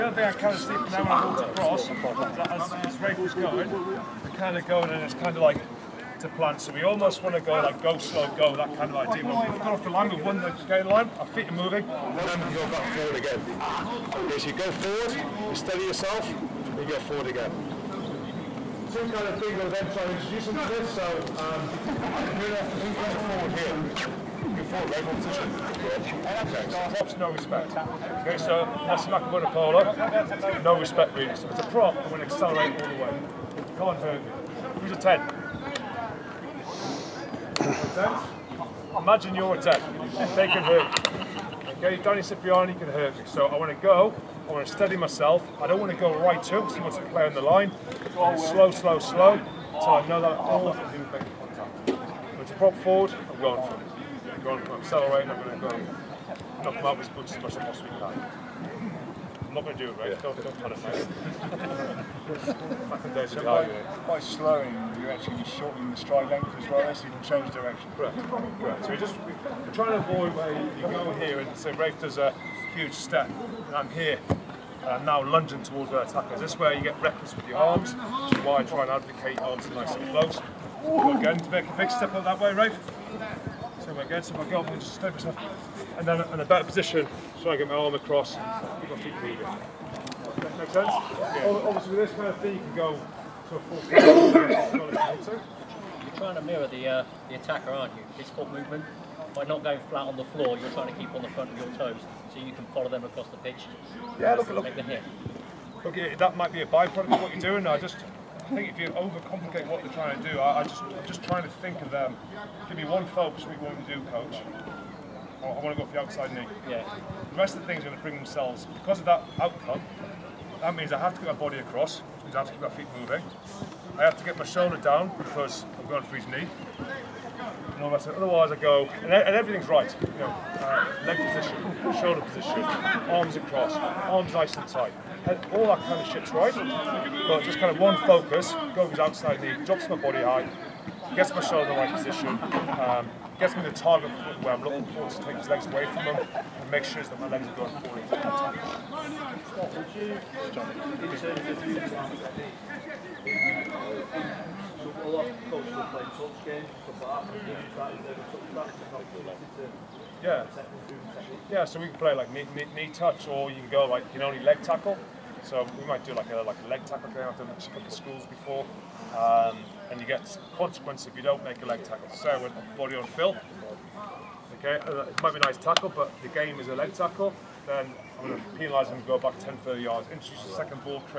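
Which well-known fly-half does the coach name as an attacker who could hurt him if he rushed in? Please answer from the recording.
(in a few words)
Danny Cipriani.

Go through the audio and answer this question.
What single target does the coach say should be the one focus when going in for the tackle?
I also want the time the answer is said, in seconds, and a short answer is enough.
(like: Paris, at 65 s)
The outside knee, at 116 s.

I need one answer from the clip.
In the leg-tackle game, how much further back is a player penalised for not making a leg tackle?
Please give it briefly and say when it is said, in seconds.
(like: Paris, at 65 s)
10 yards, at 179 s.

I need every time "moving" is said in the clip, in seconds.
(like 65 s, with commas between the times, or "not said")
11 s, 89 s, 122 s.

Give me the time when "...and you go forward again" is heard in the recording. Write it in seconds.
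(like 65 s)
16 s.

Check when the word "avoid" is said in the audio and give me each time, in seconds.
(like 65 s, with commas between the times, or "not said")
70 s.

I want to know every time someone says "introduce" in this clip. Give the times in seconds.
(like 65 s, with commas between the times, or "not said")
20 s, 180 s.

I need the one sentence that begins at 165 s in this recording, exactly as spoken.
So we might do like a, like a leg tackle game.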